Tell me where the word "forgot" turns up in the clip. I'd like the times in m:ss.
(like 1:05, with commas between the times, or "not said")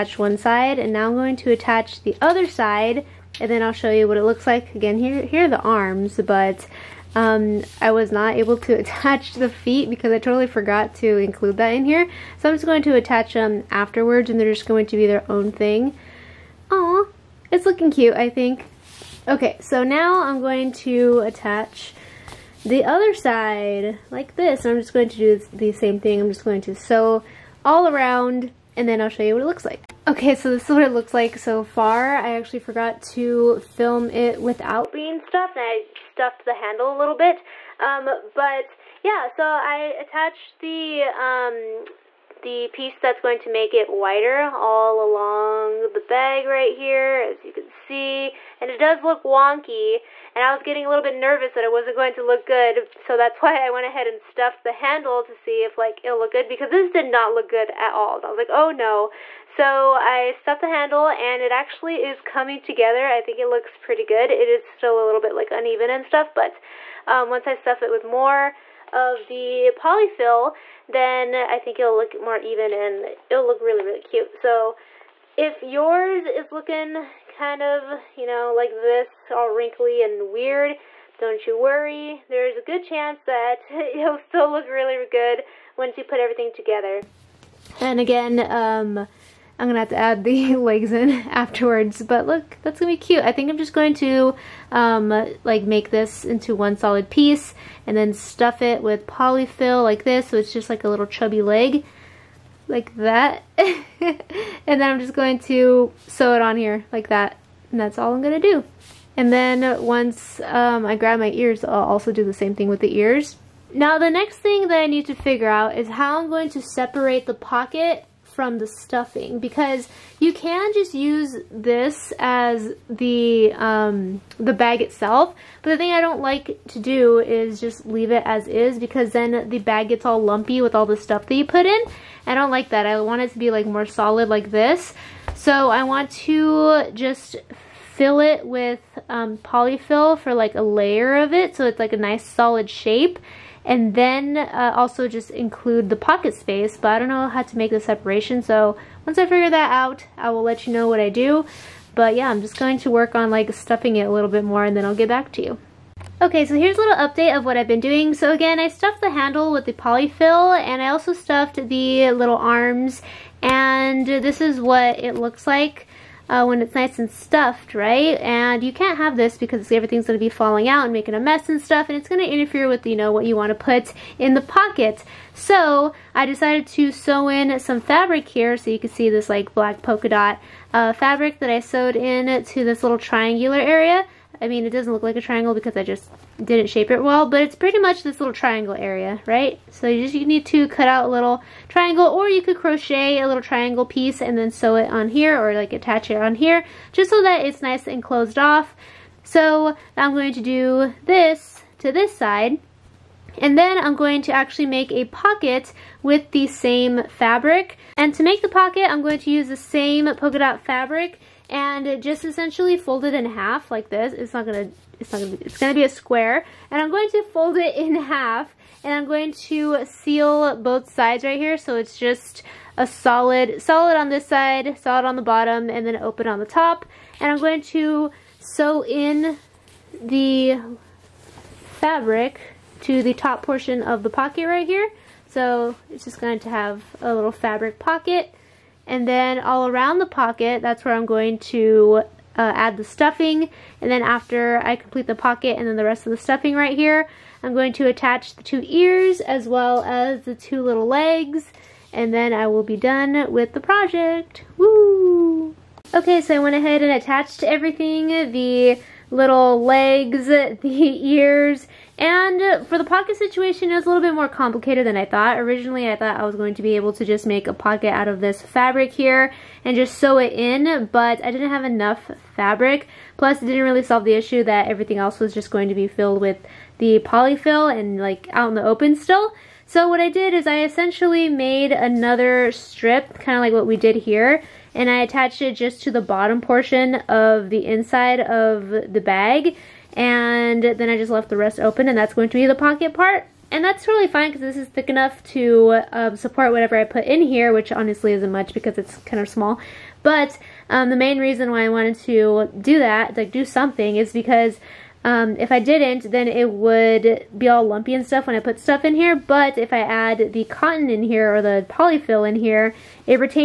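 0:10, 0:32.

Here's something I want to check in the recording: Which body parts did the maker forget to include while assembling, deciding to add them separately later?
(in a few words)
the feet.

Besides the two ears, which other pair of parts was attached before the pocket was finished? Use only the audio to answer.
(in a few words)
two little legs.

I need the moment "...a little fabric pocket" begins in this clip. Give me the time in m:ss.
3:57.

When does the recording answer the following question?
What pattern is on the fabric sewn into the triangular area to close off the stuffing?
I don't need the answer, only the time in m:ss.
2:59.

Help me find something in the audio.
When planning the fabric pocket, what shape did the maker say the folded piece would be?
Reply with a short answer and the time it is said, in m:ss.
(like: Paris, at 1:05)
a square, at 3:35.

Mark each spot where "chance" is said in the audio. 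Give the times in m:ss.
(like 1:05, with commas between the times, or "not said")
1:22.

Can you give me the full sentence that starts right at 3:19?
So I'm going to do this to this side, and then I'm going to actually make a pocket with the same fabric.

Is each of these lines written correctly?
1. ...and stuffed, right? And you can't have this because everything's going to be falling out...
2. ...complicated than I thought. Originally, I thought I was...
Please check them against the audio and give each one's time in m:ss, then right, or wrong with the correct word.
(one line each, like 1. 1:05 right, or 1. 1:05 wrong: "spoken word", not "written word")
1. 2:46 right
2. 4:24 right.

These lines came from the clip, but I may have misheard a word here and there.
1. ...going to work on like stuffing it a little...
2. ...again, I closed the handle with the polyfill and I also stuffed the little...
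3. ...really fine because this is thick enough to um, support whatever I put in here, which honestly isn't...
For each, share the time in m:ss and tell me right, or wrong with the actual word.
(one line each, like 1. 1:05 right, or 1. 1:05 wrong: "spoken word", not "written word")
1. 2:32 right
2. 2:38 wrong: "stuffed", not "closed"
3. 4:53 right.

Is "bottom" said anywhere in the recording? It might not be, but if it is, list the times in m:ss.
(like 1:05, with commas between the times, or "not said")
3:45, 4:46.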